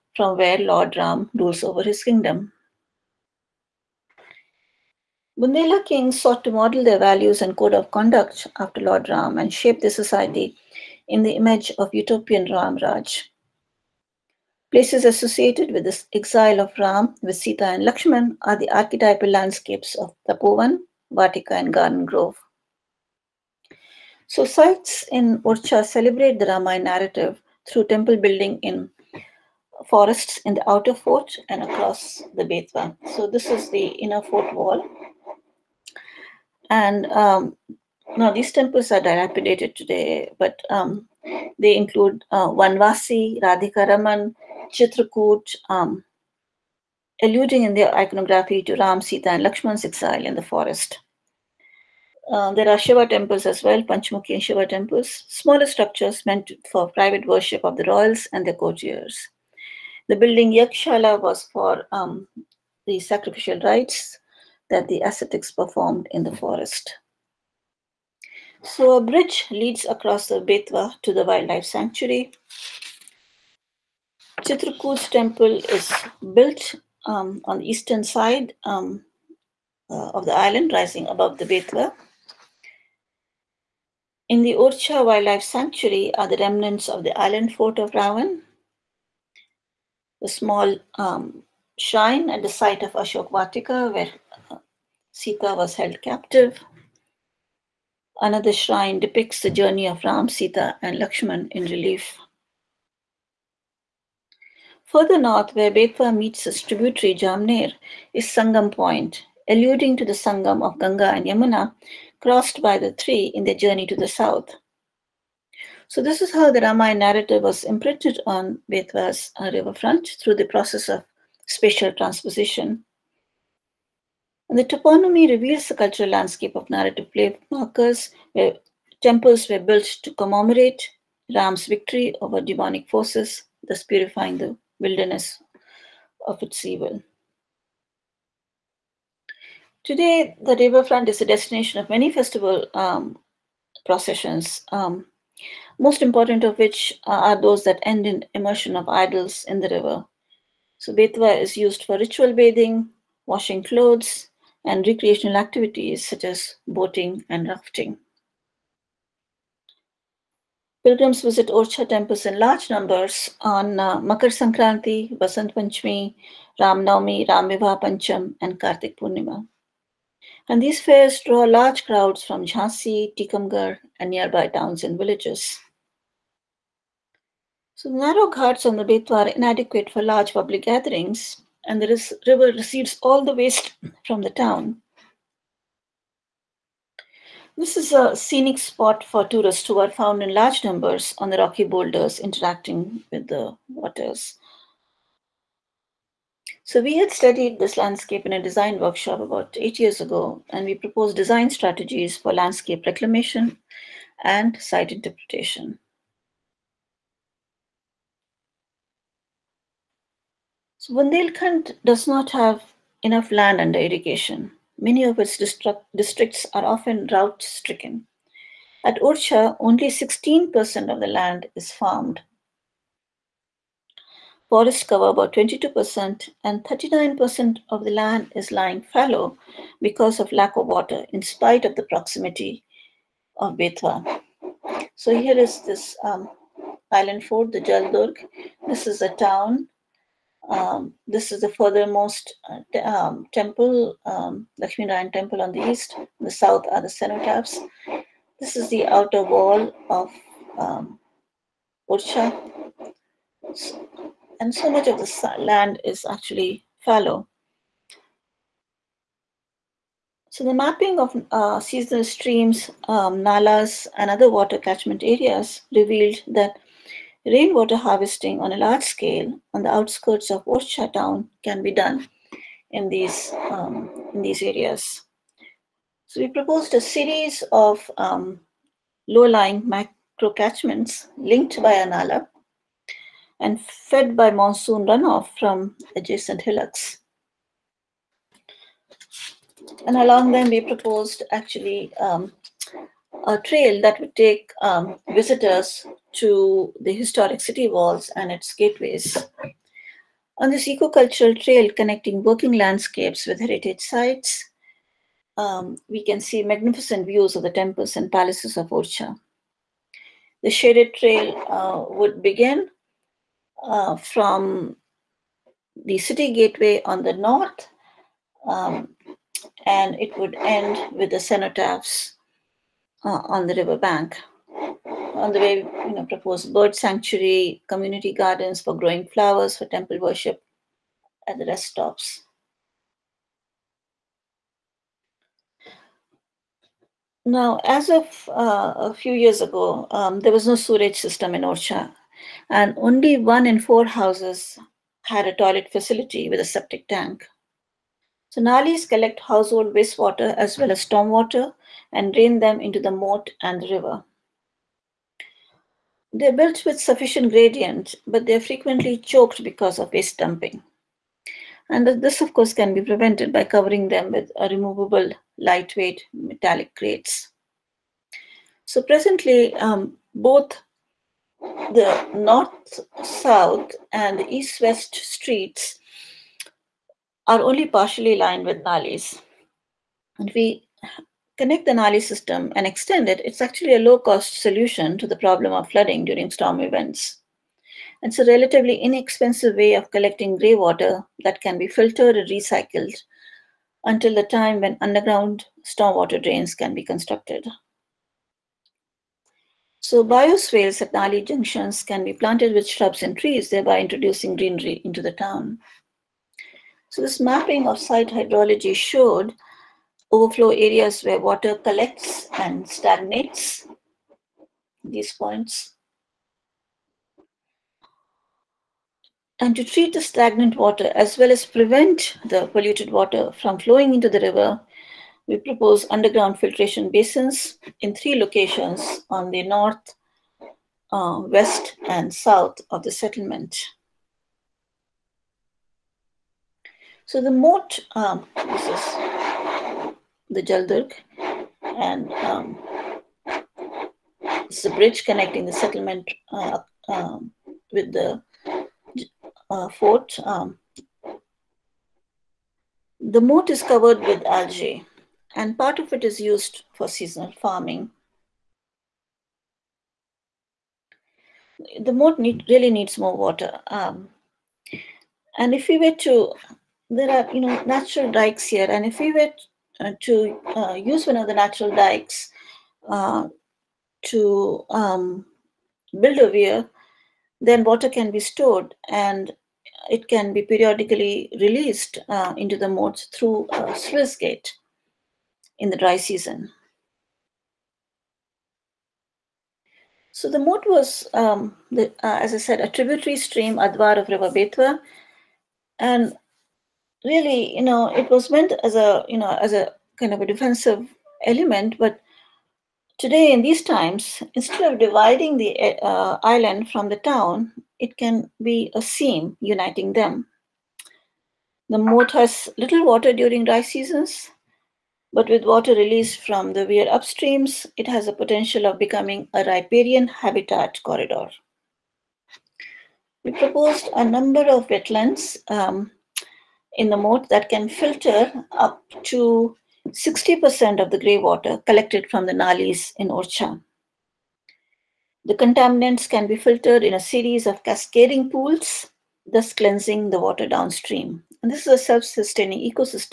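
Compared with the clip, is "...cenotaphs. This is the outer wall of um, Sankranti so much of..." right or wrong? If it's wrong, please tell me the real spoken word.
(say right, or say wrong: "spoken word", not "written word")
wrong: "And", not "Sankranti".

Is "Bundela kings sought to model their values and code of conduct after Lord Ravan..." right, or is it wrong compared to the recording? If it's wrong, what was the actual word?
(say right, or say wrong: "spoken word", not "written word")
wrong: "Ram", not "Ravan".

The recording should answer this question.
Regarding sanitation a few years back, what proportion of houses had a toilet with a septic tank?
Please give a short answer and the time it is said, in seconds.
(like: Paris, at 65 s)
one in four, at 343 s.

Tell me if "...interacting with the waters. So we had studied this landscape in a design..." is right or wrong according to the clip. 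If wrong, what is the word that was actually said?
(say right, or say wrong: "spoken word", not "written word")
right.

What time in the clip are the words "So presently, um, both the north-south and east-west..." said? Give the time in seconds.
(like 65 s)
368 s.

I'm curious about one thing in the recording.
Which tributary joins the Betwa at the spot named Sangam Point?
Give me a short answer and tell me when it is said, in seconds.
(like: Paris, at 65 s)
Jamner, at 107 s.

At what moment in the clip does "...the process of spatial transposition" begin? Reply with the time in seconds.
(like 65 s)
120 s.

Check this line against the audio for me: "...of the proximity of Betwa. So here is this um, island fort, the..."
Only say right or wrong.
right.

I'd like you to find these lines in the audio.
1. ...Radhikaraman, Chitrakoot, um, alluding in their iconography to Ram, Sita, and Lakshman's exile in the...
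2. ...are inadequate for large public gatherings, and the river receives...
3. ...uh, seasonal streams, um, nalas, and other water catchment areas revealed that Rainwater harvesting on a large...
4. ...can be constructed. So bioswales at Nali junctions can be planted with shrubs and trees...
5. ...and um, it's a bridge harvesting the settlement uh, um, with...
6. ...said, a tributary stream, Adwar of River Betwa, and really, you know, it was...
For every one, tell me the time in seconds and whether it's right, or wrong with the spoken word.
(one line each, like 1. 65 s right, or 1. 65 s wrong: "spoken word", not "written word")
1. 43 s right
2. 179 s right
3. 261 s right
4. 396 s right
5. 441 s wrong: "connecting", not "harvesting"
6. 492 s right.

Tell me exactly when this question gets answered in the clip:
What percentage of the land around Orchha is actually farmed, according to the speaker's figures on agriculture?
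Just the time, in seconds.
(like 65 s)
219 s.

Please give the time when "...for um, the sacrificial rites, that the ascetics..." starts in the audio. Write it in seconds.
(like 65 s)
61 s.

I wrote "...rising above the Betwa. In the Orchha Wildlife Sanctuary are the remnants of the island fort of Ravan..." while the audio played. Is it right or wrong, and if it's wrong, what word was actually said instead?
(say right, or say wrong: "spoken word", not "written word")
right.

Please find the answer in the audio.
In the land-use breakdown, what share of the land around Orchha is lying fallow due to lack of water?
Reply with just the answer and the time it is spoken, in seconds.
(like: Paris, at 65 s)
39%, at 226 s.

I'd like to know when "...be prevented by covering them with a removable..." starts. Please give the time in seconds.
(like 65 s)
362 s.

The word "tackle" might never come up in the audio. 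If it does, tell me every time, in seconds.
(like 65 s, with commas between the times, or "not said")
not said.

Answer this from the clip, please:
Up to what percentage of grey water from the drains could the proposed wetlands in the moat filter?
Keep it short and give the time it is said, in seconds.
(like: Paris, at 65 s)
60%, at 529 s.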